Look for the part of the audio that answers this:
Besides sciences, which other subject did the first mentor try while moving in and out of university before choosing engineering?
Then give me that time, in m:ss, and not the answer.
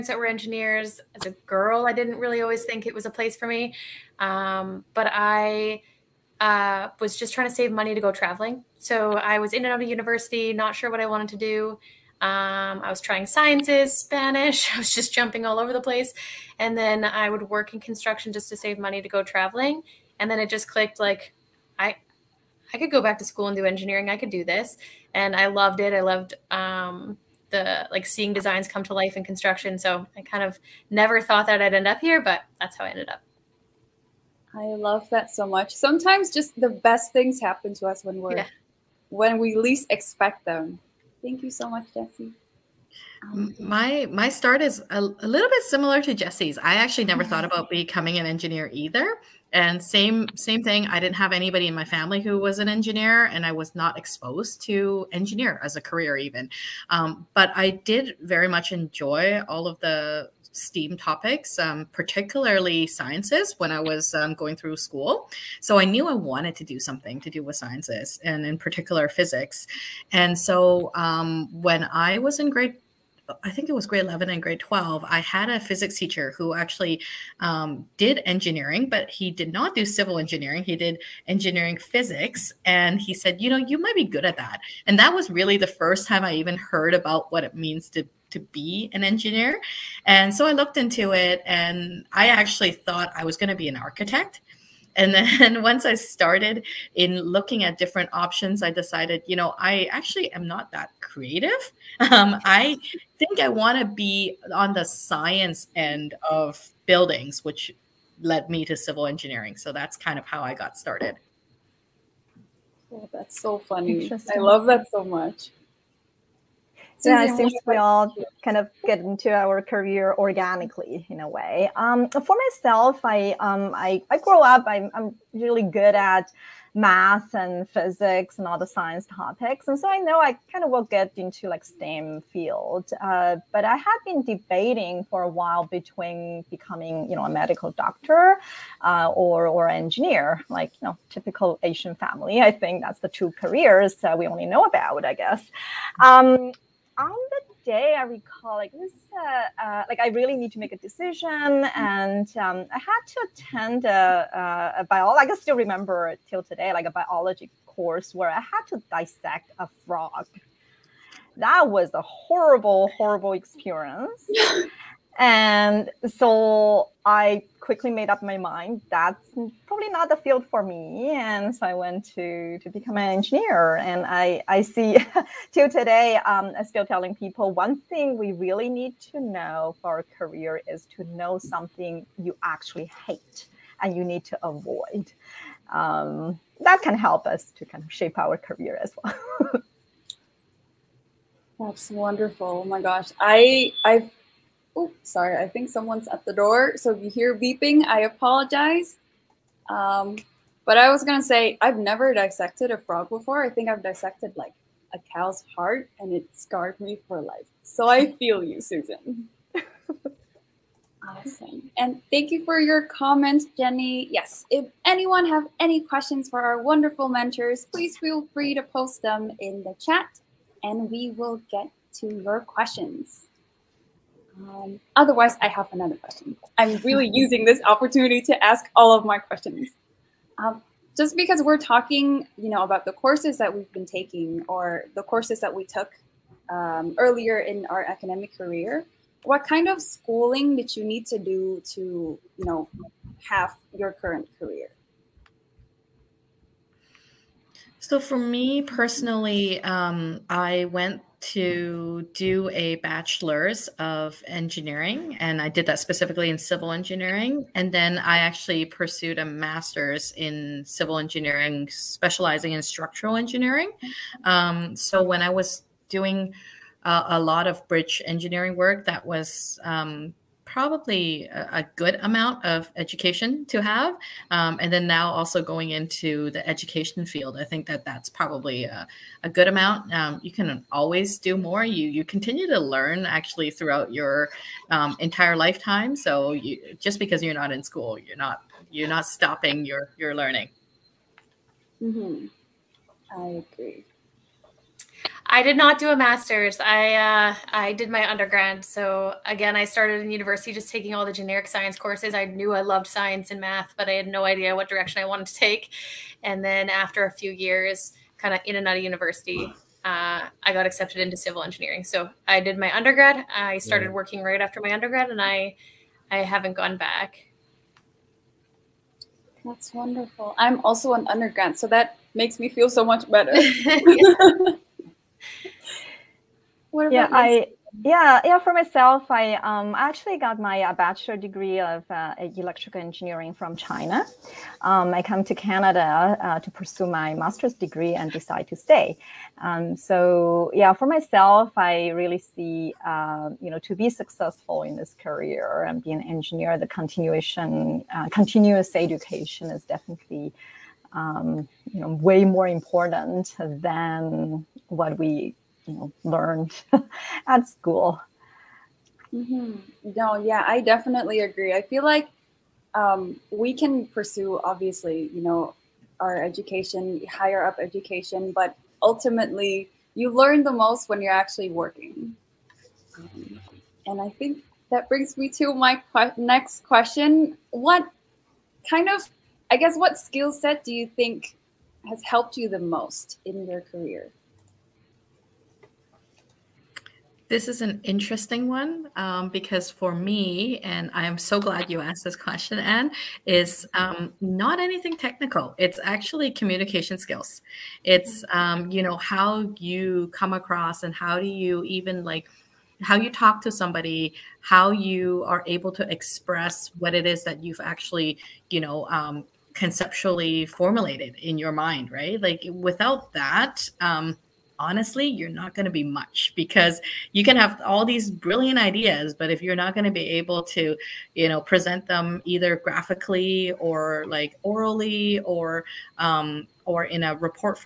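0:13.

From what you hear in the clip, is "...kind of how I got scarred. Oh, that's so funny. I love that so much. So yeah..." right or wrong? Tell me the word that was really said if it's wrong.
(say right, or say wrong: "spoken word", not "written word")
wrong: "started", not "scarred".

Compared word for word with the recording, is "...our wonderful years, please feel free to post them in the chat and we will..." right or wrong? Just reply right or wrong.
wrong.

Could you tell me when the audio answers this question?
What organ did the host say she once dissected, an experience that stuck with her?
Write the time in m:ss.
3:25.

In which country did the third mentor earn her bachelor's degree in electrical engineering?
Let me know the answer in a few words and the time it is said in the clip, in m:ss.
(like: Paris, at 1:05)
China, at 5:33.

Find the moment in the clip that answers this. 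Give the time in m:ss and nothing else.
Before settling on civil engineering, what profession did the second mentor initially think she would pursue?
1:33.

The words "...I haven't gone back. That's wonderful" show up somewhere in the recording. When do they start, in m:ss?
5:16.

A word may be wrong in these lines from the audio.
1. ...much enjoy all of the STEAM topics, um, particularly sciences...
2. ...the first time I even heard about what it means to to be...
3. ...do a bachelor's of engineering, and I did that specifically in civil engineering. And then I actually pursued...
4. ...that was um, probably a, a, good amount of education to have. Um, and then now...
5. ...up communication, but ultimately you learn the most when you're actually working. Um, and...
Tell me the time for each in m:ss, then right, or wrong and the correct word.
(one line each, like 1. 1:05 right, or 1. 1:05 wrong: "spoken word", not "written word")
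1. 0:58 right
2. 1:25 right
3. 4:12 right
4. 4:28 right
5. 6:07 wrong: "education", not "communication".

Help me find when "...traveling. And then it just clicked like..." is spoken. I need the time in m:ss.
0:19.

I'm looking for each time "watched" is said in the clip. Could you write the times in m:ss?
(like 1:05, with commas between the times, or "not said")
not said.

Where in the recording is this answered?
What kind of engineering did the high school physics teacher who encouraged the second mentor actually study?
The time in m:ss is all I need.
1:21.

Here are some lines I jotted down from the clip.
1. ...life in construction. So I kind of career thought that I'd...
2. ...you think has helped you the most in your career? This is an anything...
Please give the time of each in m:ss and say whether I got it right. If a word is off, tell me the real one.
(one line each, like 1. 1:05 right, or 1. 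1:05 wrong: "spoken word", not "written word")
1. 0:28 wrong: "never", not "career"
2. 6:20 wrong: "interesting", not "anything".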